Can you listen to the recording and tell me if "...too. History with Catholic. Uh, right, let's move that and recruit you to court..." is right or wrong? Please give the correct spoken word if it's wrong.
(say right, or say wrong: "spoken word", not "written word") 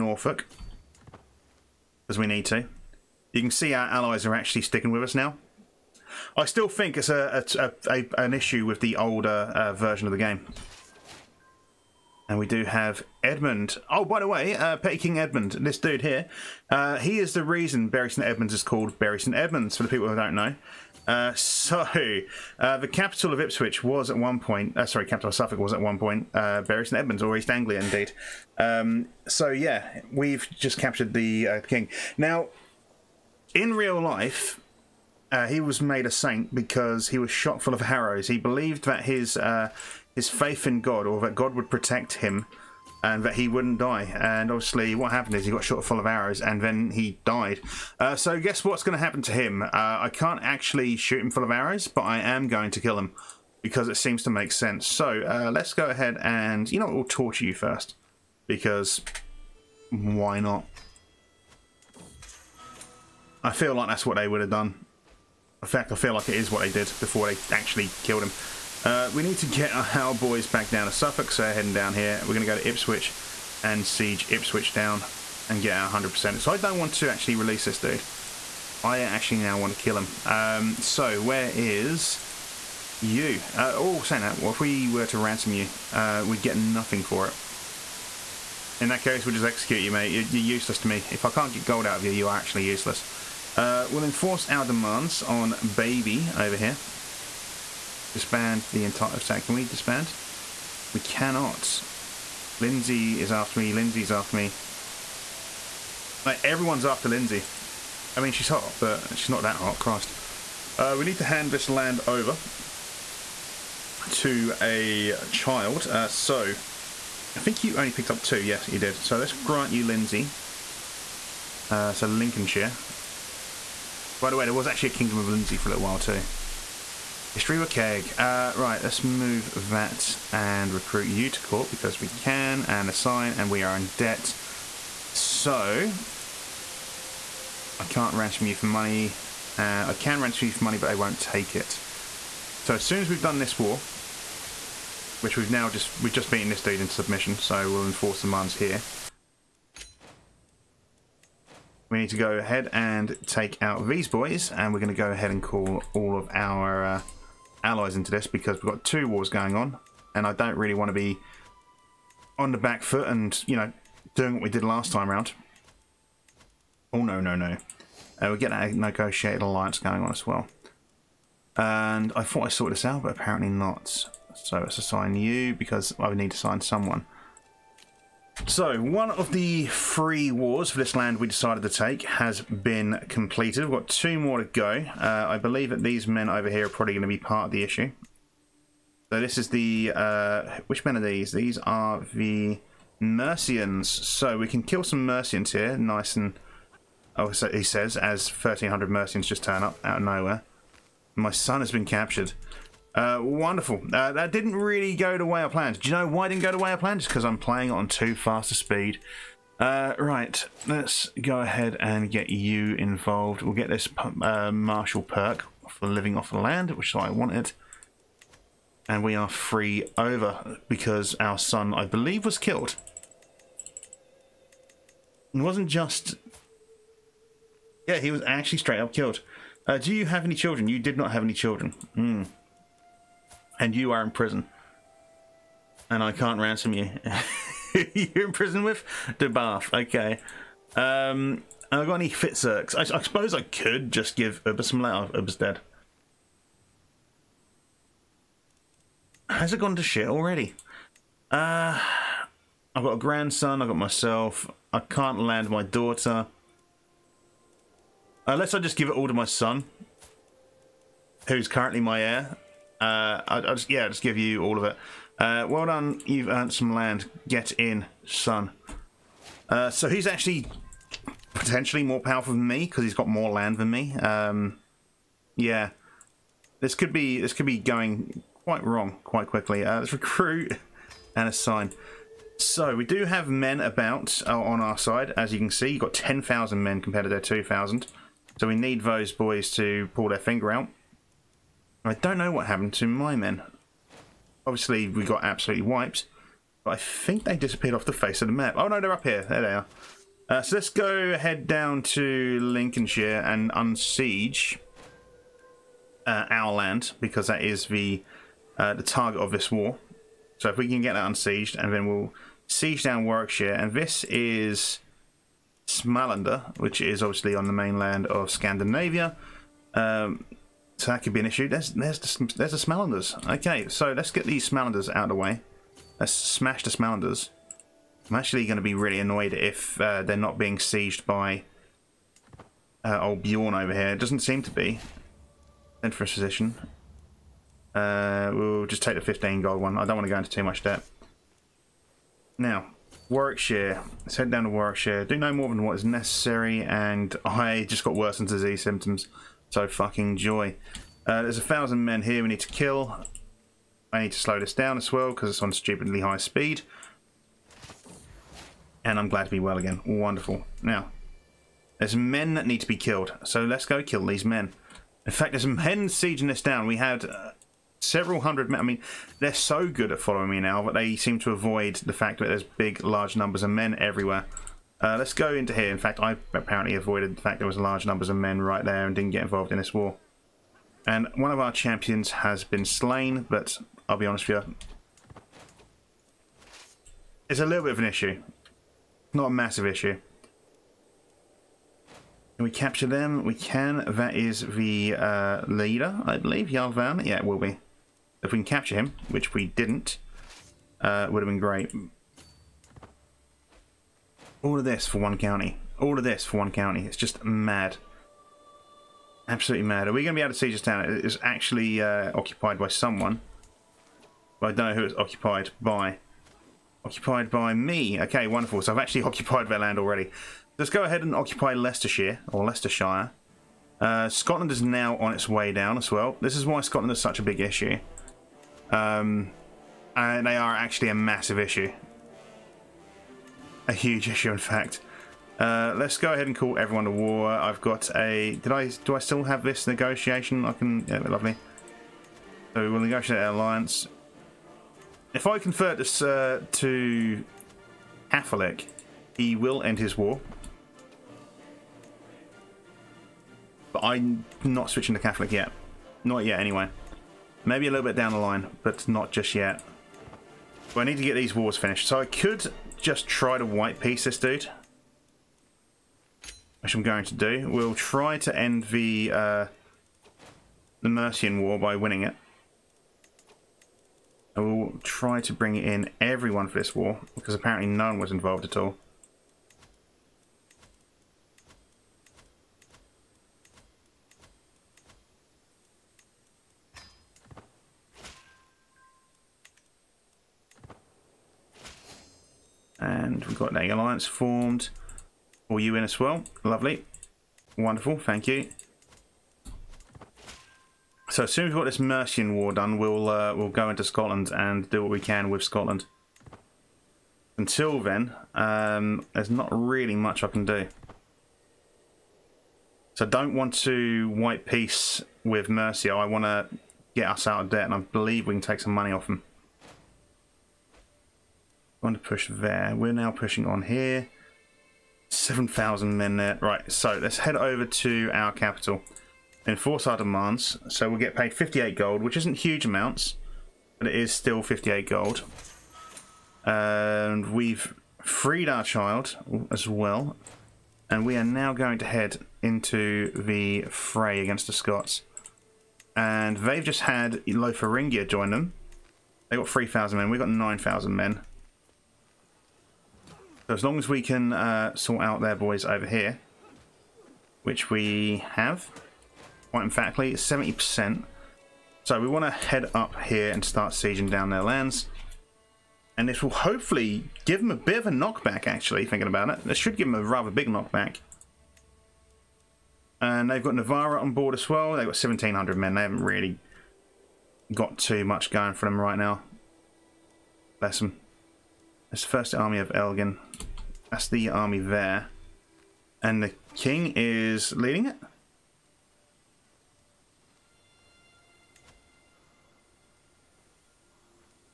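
wrong: "Keg", not "Catholic".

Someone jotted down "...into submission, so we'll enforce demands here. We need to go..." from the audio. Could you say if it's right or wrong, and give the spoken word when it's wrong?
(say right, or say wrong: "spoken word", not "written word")
right.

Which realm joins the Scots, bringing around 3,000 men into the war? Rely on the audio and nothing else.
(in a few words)
Lotharingia.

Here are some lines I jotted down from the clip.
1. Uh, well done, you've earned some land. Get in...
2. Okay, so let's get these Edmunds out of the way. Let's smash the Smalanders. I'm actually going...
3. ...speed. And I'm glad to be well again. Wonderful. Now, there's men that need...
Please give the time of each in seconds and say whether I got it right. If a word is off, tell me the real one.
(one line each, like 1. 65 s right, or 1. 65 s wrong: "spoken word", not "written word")
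1. 265 s right
2. 323 s wrong: "Smalanders", not "Edmunds"
3. 356 s right.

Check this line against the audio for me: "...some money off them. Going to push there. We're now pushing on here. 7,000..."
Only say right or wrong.
right.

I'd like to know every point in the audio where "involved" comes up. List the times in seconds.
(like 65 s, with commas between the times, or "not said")
212 s, 379 s, 478 s.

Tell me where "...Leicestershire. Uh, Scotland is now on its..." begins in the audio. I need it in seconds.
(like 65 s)
422 s.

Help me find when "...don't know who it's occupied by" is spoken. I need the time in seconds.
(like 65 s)
414 s.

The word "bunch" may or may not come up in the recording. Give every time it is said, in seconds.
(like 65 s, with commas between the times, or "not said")
not said.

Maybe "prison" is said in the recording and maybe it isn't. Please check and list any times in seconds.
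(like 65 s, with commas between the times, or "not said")
234 s, 238 s.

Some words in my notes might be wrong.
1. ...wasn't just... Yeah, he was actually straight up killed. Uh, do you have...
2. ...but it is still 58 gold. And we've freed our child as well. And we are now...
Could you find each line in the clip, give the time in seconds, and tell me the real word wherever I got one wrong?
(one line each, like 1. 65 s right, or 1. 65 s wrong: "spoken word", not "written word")
1. 225 s right
2. 533 s right.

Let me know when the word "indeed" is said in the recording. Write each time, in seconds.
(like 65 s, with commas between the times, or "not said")
27 s.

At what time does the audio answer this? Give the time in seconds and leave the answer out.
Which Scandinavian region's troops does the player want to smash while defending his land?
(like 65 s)
315 s.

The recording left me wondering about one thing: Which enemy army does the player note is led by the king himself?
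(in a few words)
First army of Elgin.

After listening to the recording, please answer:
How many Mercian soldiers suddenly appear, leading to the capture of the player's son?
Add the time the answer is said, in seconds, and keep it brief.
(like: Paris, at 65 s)
1,300, at 198 s.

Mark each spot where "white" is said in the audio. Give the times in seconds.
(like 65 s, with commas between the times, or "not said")
463 s, 514 s.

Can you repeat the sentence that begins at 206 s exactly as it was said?
Just because I'm playing on too fast a speed.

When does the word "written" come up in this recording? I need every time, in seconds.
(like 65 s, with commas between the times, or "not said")
not said.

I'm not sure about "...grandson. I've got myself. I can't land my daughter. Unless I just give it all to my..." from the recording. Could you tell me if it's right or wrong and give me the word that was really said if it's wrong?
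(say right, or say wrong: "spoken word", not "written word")
right.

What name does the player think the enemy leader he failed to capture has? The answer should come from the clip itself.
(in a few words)
Yarvan.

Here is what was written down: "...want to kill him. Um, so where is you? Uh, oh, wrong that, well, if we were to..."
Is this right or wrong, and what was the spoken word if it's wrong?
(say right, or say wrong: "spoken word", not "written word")
wrong: "saying", not "wrong".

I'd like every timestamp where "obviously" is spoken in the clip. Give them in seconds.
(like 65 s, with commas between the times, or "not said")
44 s, 294 s, 317 s.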